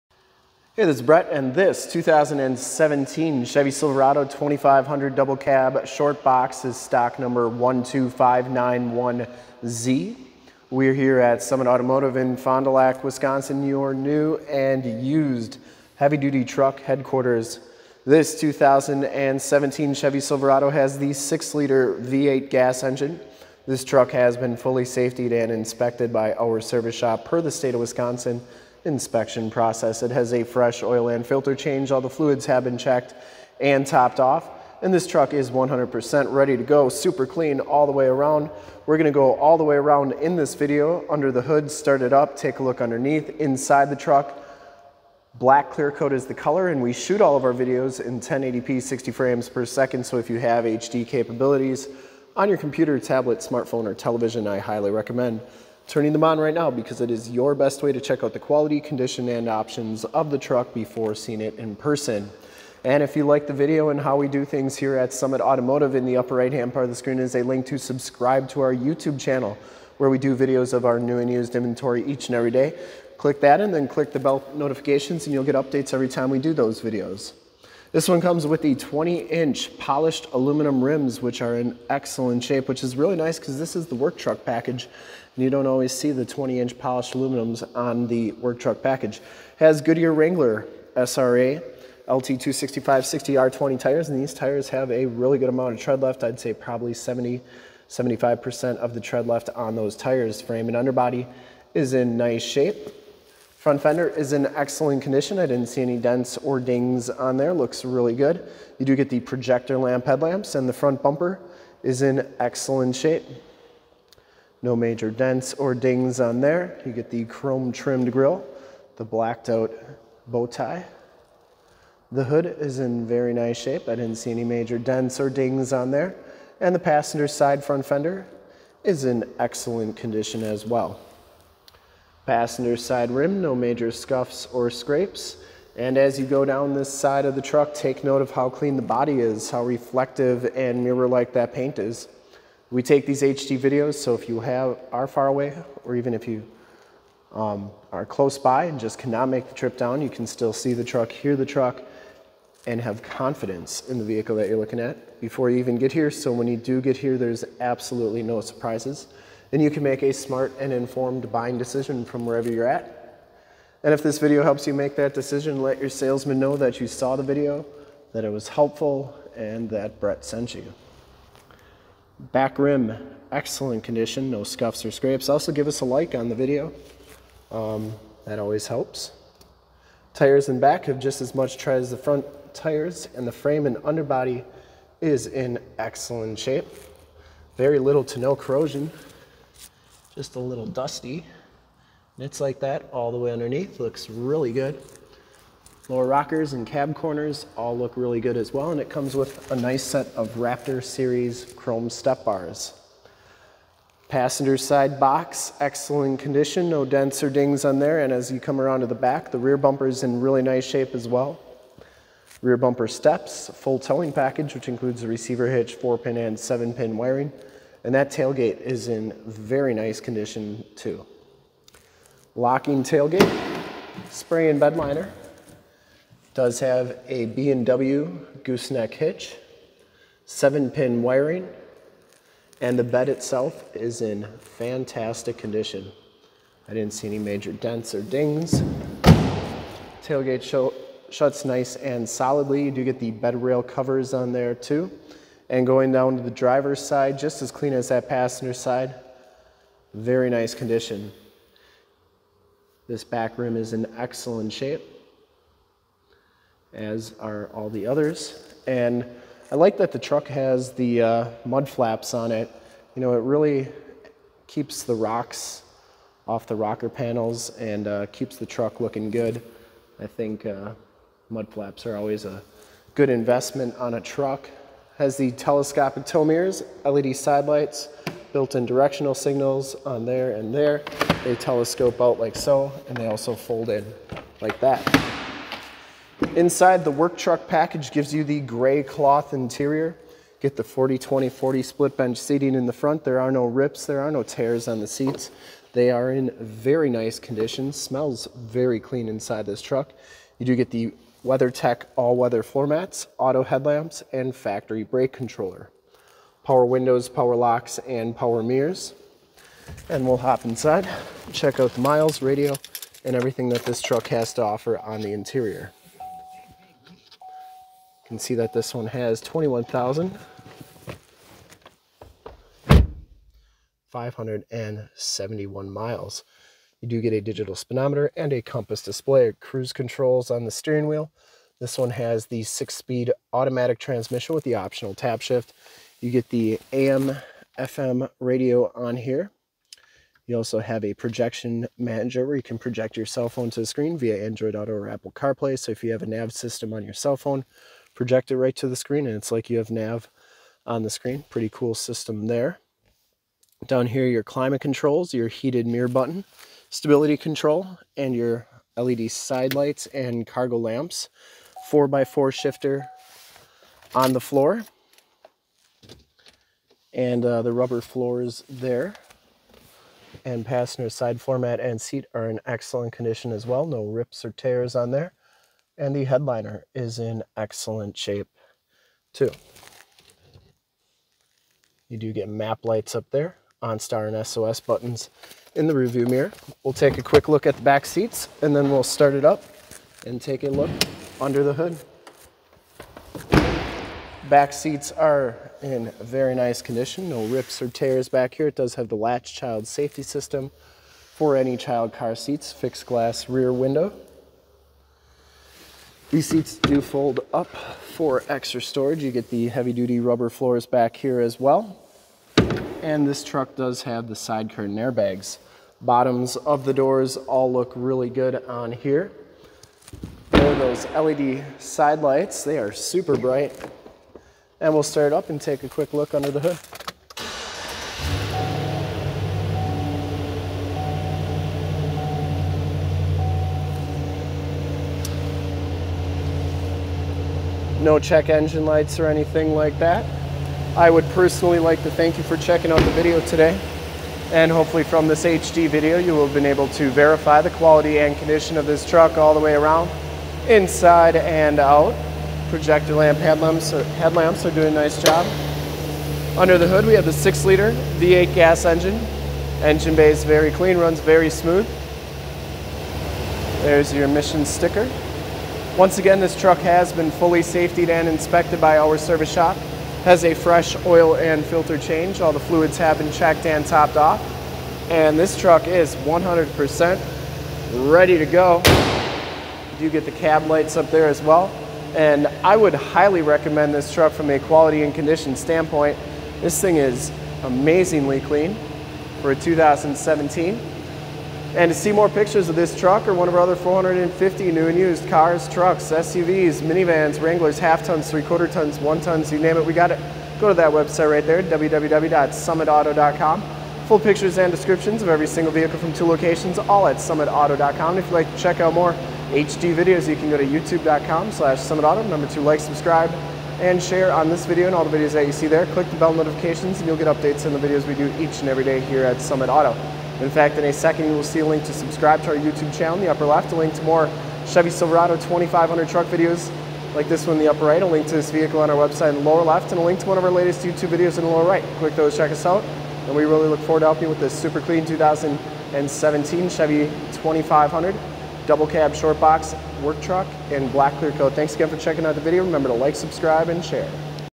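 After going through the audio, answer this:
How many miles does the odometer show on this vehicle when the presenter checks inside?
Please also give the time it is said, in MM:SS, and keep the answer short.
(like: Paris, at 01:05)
21,571, at 05:19.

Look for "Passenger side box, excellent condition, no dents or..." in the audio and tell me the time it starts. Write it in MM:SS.
03:24.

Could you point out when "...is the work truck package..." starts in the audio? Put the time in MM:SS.
01:23.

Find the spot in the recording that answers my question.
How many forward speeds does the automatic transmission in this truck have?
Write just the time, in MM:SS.
05:32.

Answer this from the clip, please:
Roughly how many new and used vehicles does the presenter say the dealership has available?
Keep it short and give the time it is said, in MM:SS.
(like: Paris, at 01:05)
450, at 08:13.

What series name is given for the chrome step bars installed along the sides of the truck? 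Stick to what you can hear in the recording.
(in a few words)
Raptor Series.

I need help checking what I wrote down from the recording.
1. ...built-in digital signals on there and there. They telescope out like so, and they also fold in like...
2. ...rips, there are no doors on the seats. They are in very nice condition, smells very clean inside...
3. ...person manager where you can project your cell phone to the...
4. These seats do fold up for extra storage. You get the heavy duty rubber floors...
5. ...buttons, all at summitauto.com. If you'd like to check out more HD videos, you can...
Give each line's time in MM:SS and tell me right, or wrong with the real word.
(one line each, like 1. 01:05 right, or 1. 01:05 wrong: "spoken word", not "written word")
1. 04:38 wrong: "directional", not "digital"
2. 04:53 wrong: "tears", not "doors"
3. 05:40 wrong: "projection", not "person"
4. 06:46 right
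5. 08:26 wrong: "locations", not "buttons".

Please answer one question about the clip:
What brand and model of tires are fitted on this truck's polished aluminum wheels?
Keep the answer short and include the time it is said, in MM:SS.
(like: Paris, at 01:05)
Goodyear Wrangler SRA, at 01:29.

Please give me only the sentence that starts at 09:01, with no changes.
Thanks again for checking out the video.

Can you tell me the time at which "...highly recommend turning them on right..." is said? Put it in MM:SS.
00:54.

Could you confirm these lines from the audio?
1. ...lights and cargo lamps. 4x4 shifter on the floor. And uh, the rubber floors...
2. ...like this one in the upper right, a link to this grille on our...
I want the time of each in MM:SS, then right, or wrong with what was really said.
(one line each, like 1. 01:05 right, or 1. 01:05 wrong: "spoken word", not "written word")
1. 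05:59 right
2. 08:46 wrong: "vehicle", not "grille".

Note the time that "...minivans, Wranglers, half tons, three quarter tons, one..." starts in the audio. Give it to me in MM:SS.
08:16.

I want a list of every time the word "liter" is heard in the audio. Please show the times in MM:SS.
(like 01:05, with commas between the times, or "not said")
00:21, 07:37.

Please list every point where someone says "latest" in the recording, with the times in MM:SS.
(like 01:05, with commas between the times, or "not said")
08:50.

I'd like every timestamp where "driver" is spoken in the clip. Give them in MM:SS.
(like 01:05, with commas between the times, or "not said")
04:06.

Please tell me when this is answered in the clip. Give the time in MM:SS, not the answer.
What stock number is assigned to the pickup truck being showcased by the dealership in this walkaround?
00:07.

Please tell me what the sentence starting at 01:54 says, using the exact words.
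No major dents or dings on there.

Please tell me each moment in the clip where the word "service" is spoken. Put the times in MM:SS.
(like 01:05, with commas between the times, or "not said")
00:26, 07:48.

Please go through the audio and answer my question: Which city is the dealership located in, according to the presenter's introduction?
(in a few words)
Fond du Lac.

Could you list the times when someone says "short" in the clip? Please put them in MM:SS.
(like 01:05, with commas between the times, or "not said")
00:05, 08:58.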